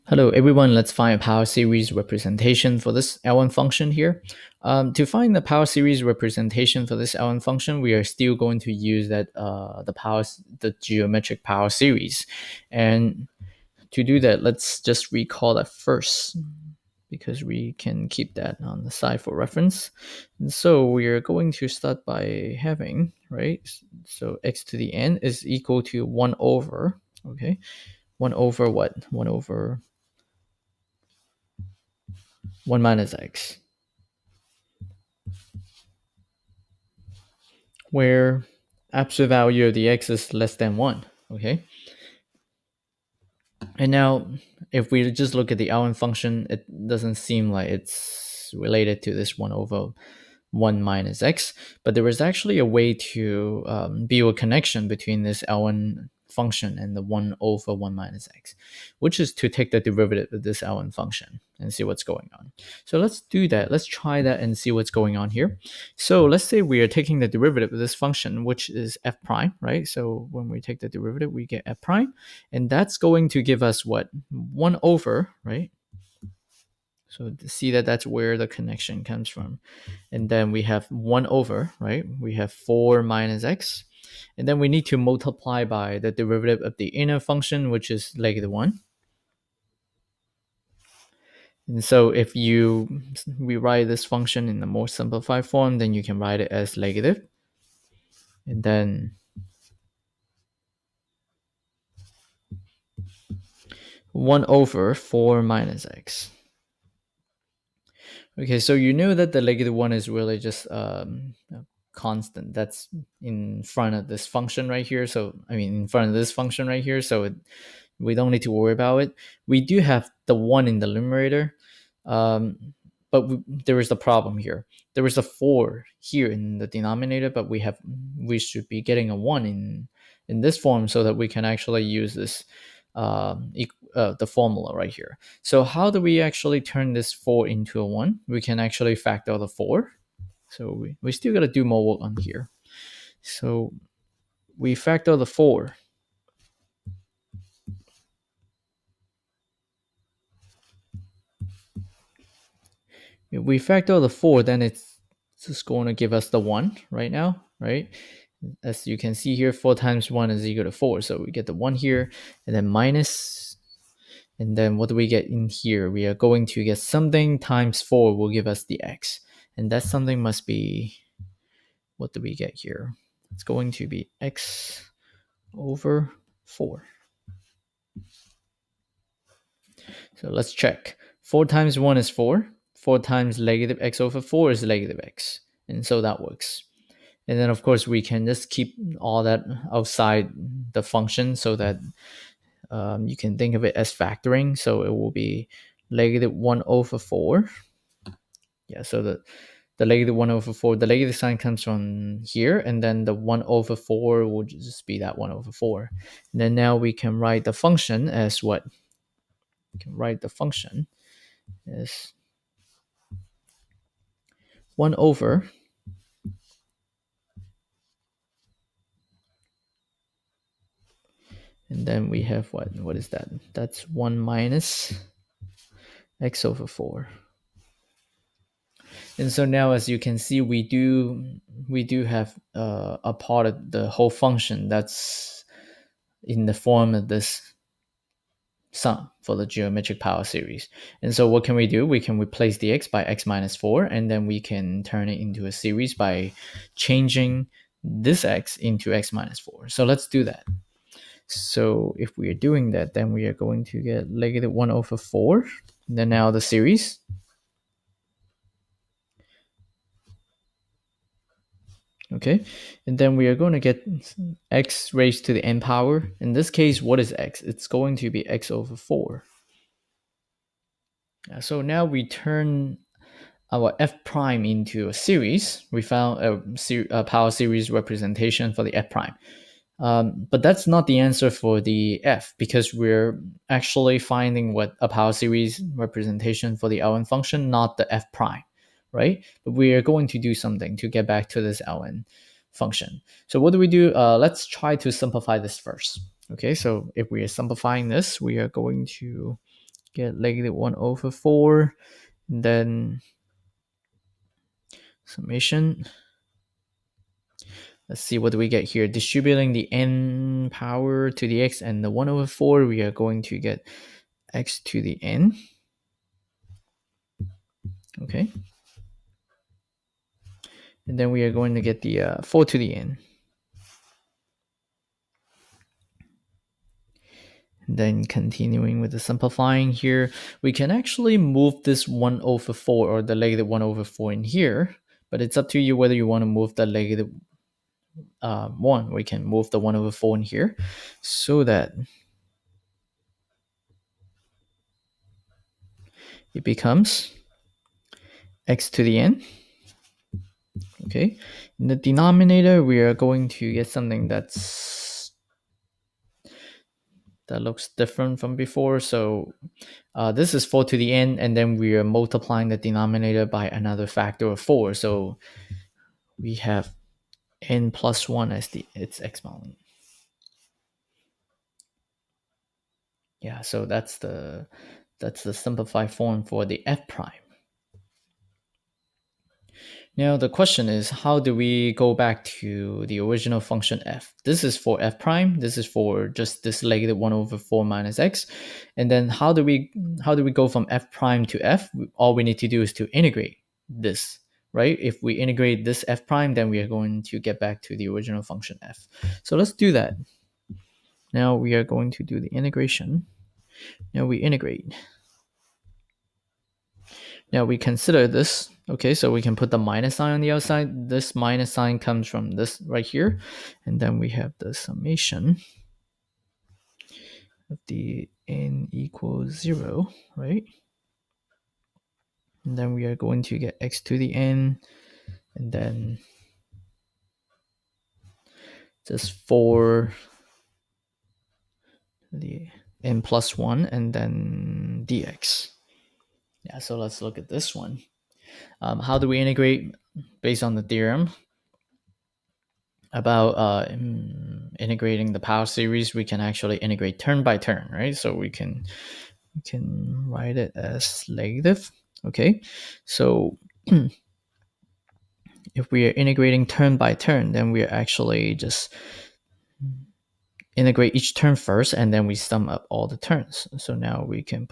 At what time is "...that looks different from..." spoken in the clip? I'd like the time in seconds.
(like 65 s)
357 s.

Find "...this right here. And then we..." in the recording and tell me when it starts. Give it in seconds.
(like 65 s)
412 s.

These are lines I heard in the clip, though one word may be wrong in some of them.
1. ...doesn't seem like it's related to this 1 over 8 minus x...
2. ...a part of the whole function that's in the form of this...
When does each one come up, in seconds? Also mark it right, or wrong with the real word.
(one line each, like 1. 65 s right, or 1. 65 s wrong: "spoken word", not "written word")
1. 46 s wrong: "1", not "8"
2. 233 s right.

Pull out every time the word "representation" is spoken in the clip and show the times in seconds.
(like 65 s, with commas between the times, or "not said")
1 s, 6 s, 277 s, 285 s.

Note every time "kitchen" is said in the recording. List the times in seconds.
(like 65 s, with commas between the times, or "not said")
not said.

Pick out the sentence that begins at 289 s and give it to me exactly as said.
But we are going to do something to get back to this ln function.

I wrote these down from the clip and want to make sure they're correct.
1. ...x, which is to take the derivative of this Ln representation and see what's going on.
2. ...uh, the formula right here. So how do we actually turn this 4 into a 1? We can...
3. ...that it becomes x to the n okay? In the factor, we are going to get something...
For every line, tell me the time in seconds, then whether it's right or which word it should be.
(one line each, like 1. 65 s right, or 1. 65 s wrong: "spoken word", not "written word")
1. 58 s wrong: "function", not "representation"
2. 133 s right
3. 341 s wrong: "denominator", not "factor".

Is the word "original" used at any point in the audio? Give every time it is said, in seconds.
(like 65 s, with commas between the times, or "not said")
383 s, 397 s.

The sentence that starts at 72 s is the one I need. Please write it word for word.
And that's going to give us what?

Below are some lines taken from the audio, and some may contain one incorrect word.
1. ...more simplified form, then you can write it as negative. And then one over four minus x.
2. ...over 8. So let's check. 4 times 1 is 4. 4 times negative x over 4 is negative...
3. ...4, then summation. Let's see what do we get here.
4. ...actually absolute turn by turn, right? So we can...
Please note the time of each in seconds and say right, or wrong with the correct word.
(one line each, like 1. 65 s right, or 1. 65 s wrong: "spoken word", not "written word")
1. 94 s right
2. 175 s wrong: "4", not "8"
3. 301 s right
4. 446 s wrong: "integrate", not "absolute".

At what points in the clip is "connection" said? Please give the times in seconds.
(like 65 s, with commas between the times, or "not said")
54 s, 78 s.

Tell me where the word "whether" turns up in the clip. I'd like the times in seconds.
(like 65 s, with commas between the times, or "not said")
335 s.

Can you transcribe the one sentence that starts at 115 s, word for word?
So I mean, in front of this function right here.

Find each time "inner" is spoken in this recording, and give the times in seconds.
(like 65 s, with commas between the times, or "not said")
86 s.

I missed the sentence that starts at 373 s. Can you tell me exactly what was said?
Yeah, so that's the that's the simplified form for the f prime.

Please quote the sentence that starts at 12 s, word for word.
And to do that, let's just recall that first because we can keep that on the side for reference.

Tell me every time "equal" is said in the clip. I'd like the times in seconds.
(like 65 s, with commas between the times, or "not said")
25 s, 160 s, 418 s.